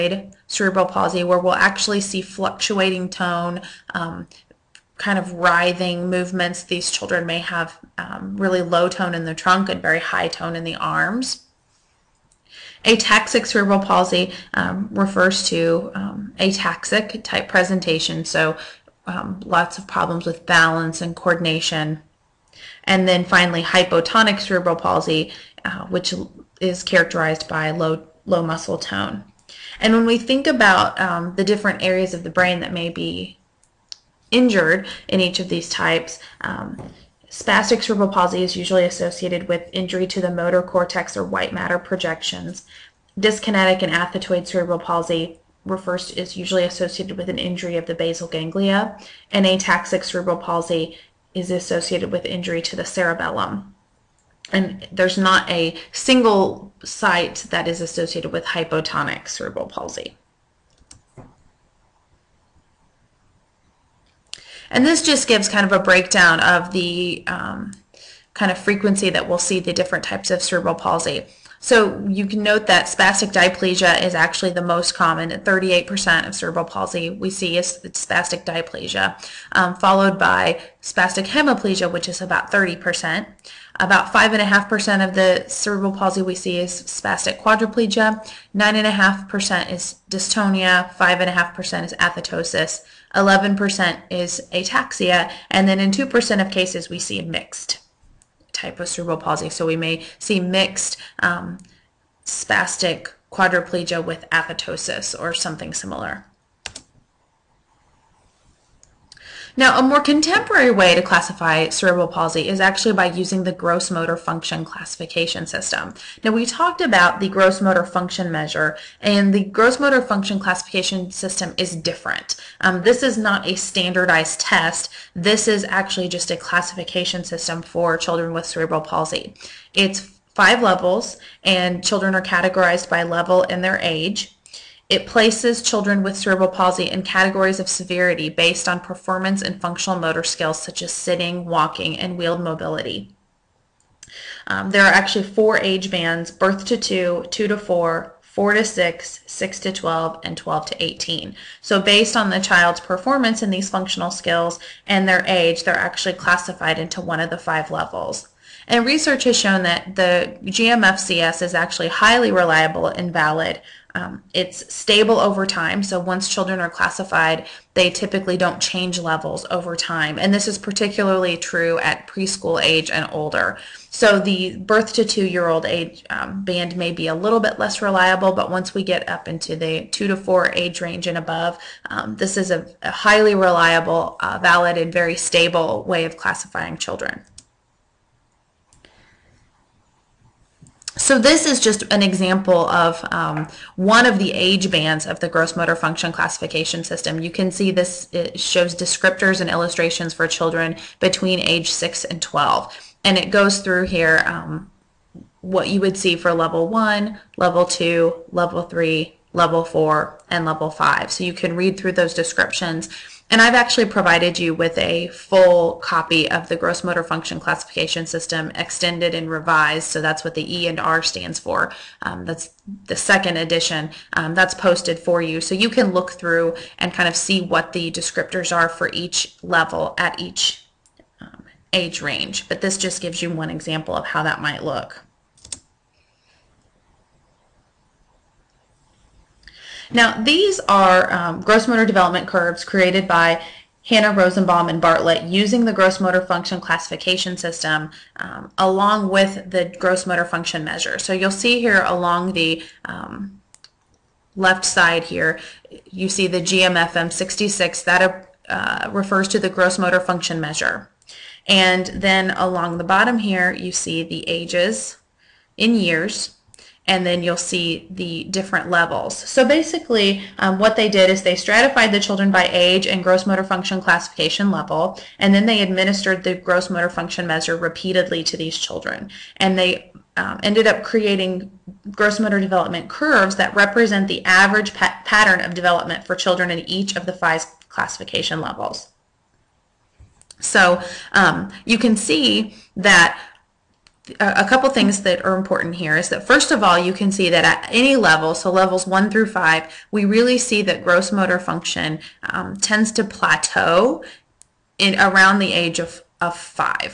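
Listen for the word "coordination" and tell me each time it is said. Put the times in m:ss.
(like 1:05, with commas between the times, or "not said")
0:21.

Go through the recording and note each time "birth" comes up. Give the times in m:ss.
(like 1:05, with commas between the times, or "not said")
2:26, 2:54.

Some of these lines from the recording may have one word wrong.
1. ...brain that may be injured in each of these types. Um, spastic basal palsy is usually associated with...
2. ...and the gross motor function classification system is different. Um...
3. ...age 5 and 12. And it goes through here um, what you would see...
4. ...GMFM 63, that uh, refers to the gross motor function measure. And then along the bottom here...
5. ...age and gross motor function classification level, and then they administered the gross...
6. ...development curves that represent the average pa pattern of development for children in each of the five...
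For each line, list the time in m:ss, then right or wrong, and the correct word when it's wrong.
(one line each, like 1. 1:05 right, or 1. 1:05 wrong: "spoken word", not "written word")
1. 0:32 wrong: "cerebral", not "basal"
2. 1:59 right
3. 3:21 wrong: "6", not "5"
4. 4:16 wrong: "66", not "63"
5. 4:32 right
6. 4:42 right.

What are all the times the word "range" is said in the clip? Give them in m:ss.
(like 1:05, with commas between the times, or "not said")
3:00, 3:52.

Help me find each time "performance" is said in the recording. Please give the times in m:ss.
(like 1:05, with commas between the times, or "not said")
2:18, 2:32.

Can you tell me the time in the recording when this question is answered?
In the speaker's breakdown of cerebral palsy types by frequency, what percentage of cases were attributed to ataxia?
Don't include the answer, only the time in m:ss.
1:33.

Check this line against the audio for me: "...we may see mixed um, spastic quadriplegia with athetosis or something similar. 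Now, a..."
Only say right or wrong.
right.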